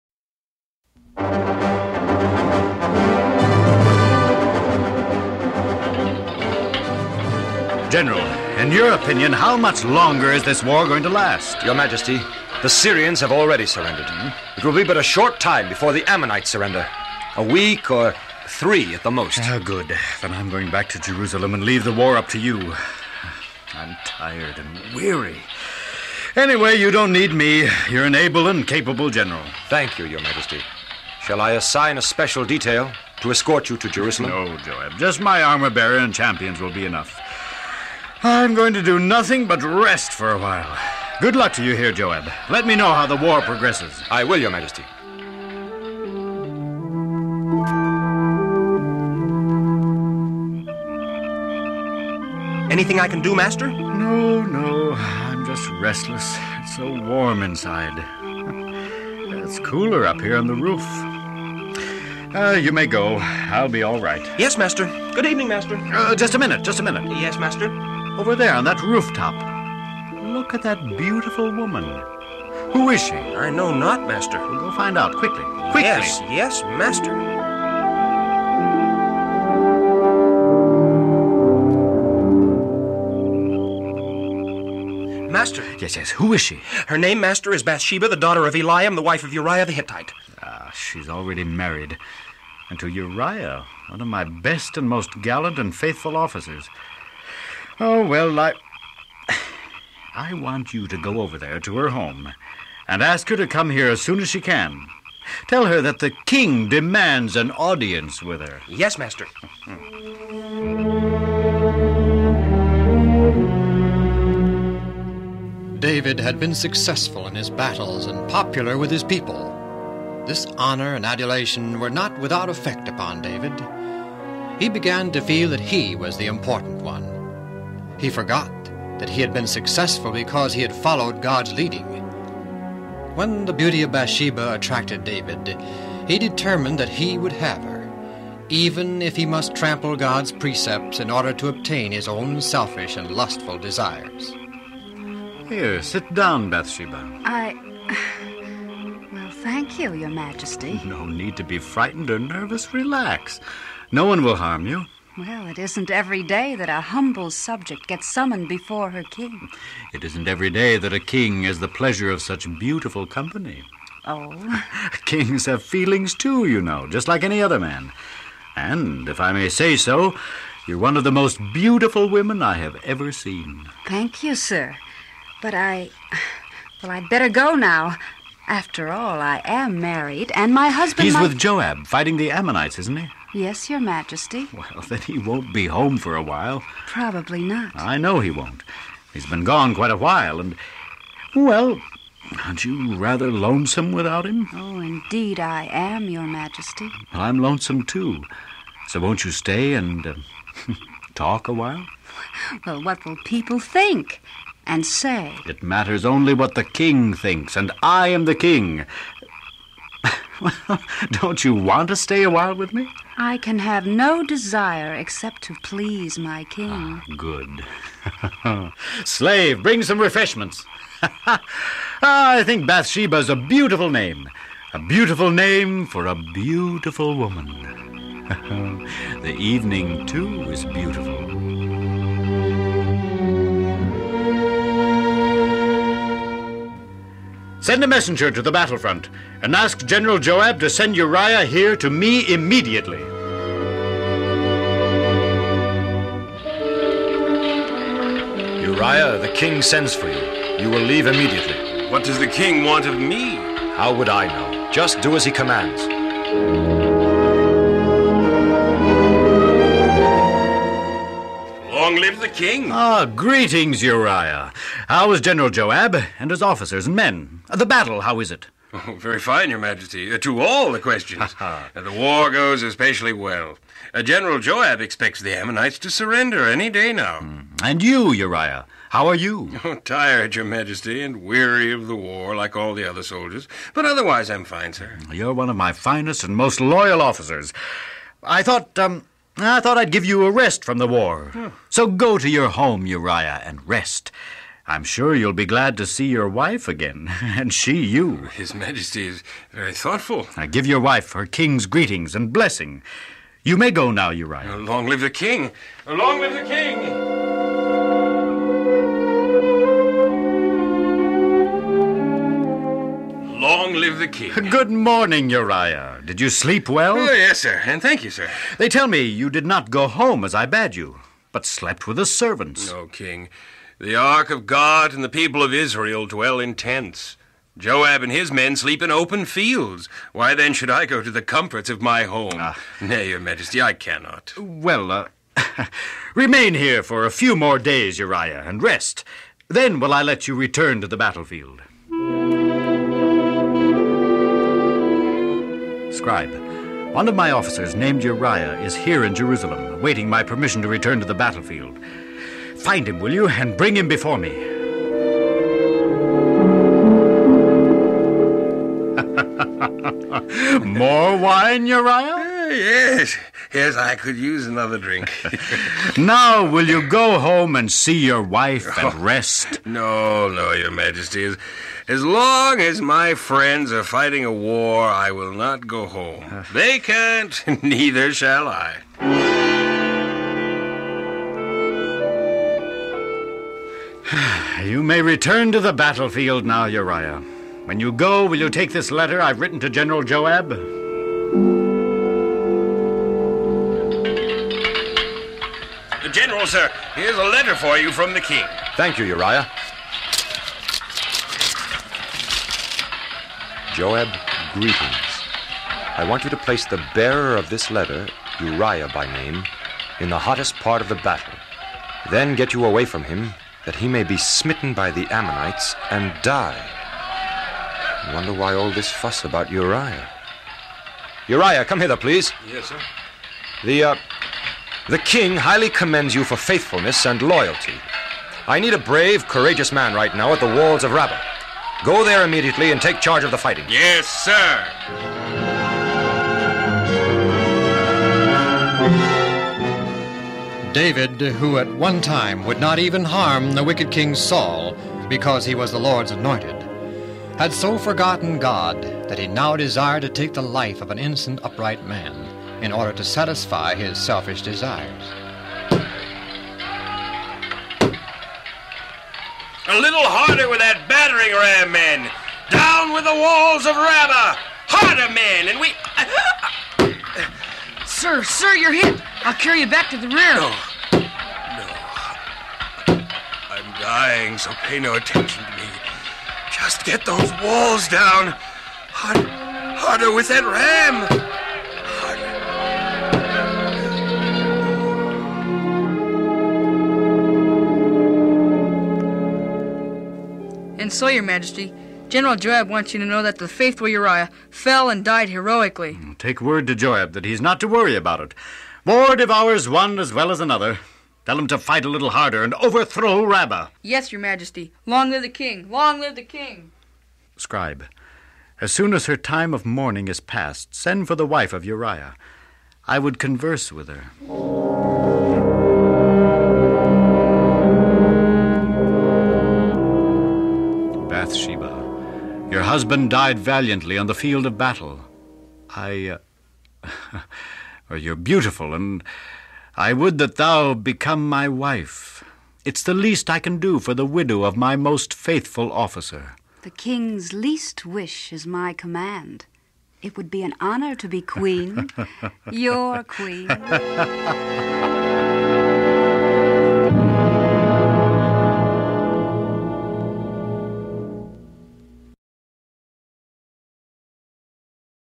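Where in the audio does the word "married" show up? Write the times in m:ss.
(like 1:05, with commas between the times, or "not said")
1:31, 2:59.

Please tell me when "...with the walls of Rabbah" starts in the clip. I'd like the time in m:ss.
7:42.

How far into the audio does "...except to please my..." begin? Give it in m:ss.
3:34.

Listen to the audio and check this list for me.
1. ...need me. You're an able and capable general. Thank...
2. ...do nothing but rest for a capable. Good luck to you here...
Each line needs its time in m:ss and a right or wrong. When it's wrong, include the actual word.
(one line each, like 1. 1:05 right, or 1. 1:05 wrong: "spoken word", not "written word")
1. 0:27 right
2. 0:38 wrong: "while", not "capable".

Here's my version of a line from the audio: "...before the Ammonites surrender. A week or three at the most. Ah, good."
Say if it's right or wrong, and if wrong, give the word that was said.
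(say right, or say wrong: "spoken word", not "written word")
right.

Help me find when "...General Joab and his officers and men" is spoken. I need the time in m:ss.
4:25.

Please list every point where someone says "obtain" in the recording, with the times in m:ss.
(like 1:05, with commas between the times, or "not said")
2:21.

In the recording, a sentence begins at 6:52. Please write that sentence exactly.
Then get you away from him, that he may be smitten by the Ammonites and die.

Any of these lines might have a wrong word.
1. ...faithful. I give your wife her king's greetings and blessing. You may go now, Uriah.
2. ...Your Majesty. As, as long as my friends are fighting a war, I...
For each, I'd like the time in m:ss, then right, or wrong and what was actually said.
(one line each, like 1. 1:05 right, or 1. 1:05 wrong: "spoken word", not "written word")
1. 4:59 wrong: "thoughtful", not "faithful"
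2. 6:10 right.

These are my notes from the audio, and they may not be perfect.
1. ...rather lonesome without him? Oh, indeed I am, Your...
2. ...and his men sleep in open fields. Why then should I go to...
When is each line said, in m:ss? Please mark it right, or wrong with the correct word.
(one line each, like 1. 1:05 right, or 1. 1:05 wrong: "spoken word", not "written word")
1. 3:12 right
2. 5:28 right.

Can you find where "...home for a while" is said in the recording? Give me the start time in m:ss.
3:05.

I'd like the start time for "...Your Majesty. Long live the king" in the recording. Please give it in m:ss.
8:24.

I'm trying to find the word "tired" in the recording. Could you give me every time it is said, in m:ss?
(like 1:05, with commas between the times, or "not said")
0:24, 4:39.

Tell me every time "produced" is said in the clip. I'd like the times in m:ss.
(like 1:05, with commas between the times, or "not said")
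not said.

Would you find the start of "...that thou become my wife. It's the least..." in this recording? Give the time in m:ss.
8:50.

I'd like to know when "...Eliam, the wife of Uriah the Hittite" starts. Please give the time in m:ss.
1:28.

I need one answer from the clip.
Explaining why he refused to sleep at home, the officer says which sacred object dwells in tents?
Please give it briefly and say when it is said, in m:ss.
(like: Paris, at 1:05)
The ark of God, at 5:23.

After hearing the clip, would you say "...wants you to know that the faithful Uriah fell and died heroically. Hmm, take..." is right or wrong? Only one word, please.
right.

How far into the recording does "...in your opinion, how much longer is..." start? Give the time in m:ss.
0:08.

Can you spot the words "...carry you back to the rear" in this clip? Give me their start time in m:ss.
7:49.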